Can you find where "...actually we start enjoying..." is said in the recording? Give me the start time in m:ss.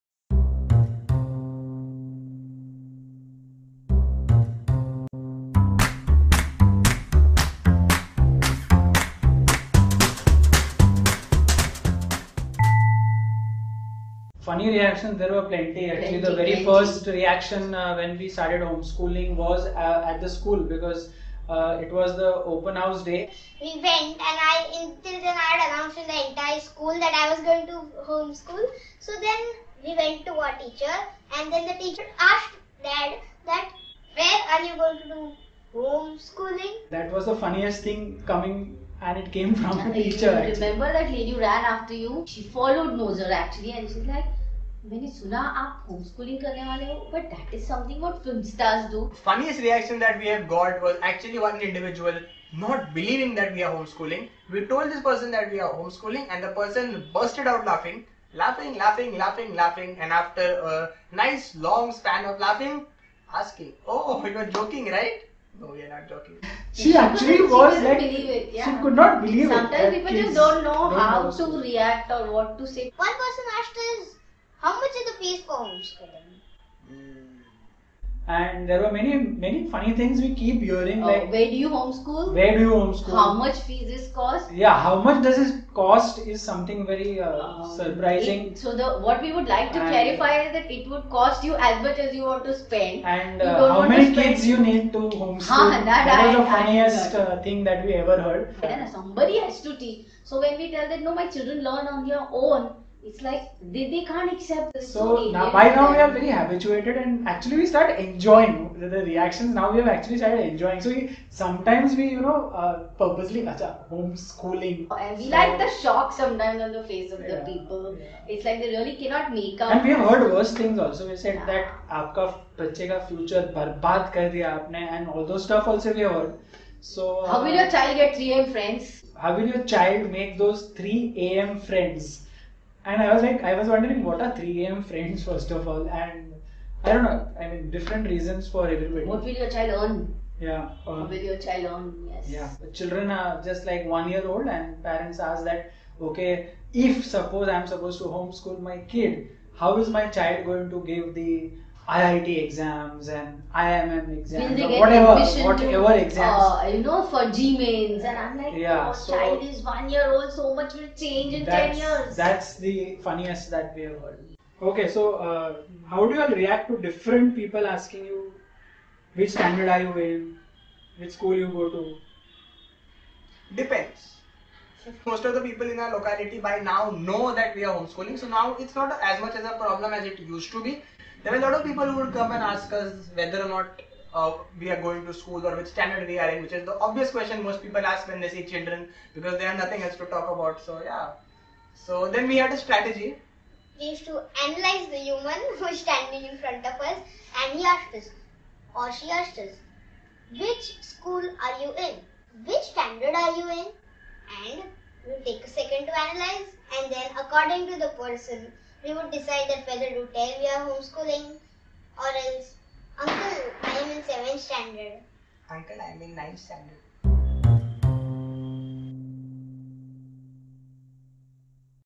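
1:47.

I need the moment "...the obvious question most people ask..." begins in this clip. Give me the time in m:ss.
3:06.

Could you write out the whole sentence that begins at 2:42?
That's the funniest that we have heard.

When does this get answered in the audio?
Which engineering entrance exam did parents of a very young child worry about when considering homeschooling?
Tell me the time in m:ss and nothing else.
2:37.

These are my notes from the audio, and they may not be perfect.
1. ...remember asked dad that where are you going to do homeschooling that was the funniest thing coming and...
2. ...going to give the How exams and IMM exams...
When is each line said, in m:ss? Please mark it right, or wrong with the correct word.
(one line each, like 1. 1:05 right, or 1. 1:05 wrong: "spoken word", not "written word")
1. 0:31 wrong: "teacher", not "remember"
2. 2:30 wrong: "IIT", not "How".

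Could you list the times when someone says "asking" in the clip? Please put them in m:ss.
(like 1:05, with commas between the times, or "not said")
1:03, 2:47.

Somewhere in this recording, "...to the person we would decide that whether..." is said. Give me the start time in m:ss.
3:27.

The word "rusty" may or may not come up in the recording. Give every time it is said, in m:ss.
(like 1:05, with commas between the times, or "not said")
not said.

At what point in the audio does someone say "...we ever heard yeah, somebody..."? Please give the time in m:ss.
1:37.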